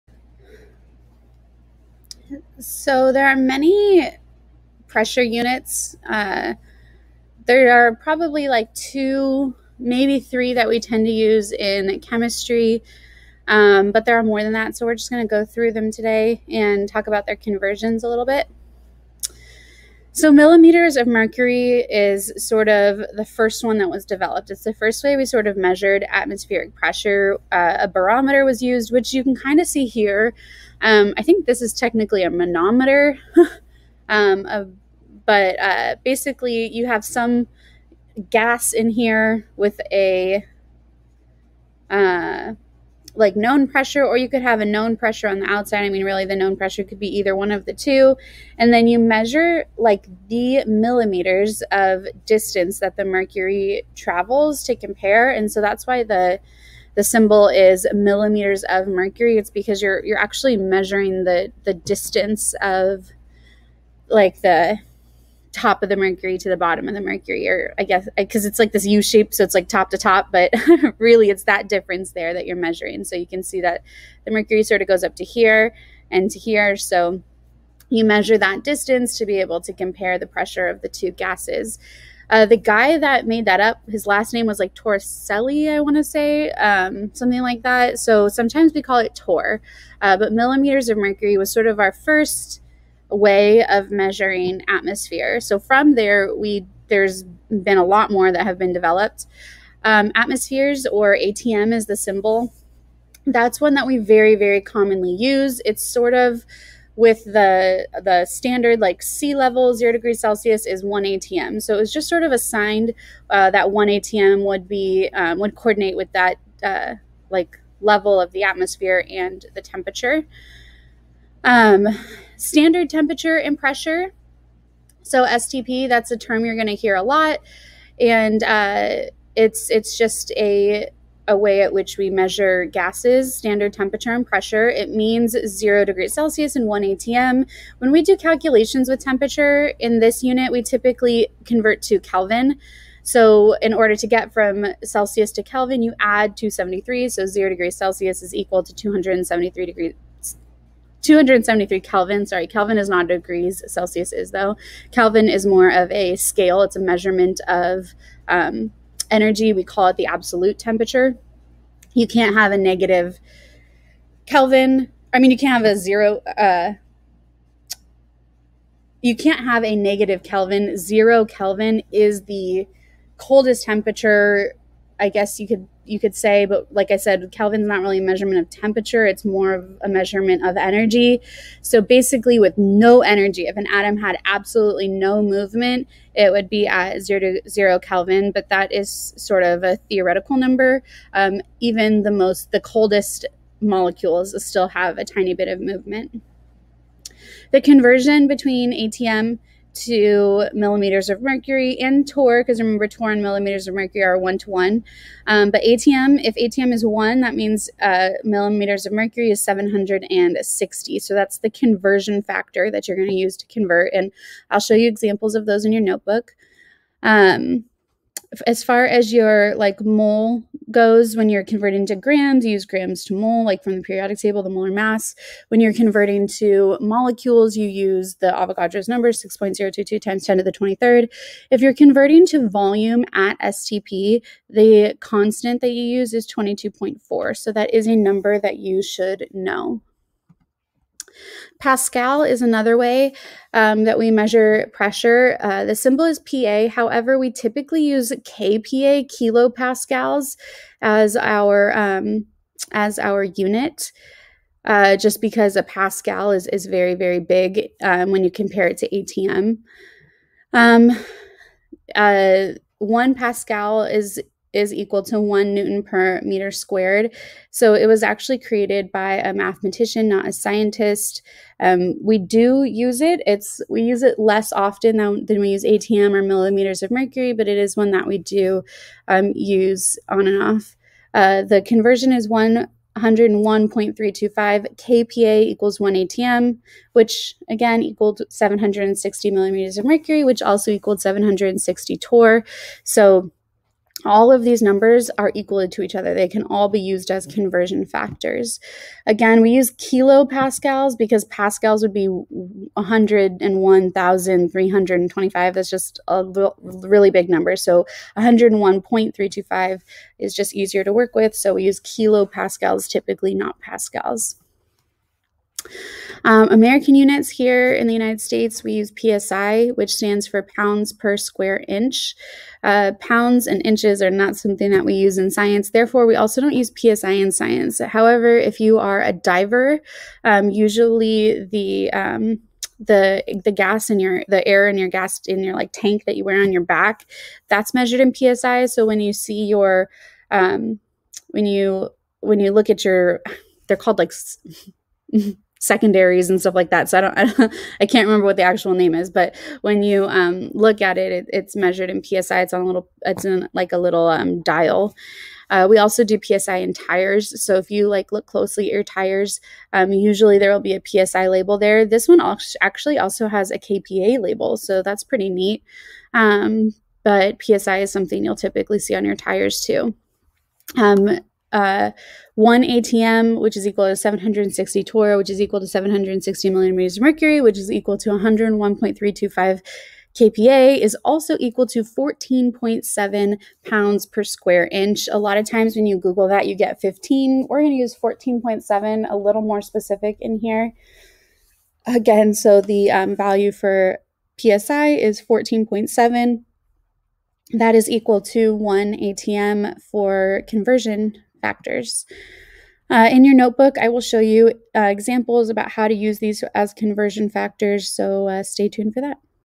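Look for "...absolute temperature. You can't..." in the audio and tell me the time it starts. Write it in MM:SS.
02:40.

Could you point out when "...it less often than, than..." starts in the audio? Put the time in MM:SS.
04:34.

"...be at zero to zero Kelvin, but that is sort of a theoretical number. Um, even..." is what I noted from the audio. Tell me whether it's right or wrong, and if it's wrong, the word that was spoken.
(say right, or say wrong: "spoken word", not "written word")
right.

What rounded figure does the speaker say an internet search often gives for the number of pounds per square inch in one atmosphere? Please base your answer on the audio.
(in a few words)
15.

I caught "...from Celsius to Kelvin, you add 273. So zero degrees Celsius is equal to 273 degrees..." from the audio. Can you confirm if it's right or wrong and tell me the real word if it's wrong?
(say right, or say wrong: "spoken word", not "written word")
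right.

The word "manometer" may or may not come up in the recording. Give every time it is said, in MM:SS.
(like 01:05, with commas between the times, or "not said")
00:32.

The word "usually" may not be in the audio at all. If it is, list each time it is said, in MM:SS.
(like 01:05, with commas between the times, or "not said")
05:30, 05:59.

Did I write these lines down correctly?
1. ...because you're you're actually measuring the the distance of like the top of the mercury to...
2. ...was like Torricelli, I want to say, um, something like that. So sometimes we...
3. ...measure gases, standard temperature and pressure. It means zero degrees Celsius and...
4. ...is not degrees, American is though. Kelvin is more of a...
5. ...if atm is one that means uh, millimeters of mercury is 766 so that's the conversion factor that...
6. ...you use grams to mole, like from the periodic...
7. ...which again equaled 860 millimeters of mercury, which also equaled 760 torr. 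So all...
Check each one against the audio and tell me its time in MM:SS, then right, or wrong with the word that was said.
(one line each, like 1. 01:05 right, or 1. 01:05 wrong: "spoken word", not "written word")
1. 00:59 right
2. 01:24 right
3. 02:12 right
4. 02:32 wrong: "Celsius", not "American"
5. 03:26 wrong: "760", not "766"
6. 03:42 right
7. 04:46 wrong: "760", not "860".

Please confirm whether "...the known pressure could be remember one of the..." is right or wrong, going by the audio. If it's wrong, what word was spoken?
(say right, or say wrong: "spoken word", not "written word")
wrong: "either", not "remember".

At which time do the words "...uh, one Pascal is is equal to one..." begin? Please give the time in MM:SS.
04:21.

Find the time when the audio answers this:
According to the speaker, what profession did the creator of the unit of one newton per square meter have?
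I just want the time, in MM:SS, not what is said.
04:29.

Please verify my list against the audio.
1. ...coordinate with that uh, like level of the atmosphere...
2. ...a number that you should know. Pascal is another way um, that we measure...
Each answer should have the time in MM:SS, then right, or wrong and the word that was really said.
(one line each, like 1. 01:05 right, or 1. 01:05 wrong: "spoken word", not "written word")
1. 01:55 right
2. 03:57 right.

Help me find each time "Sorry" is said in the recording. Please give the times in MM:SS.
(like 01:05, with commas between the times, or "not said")
02:32.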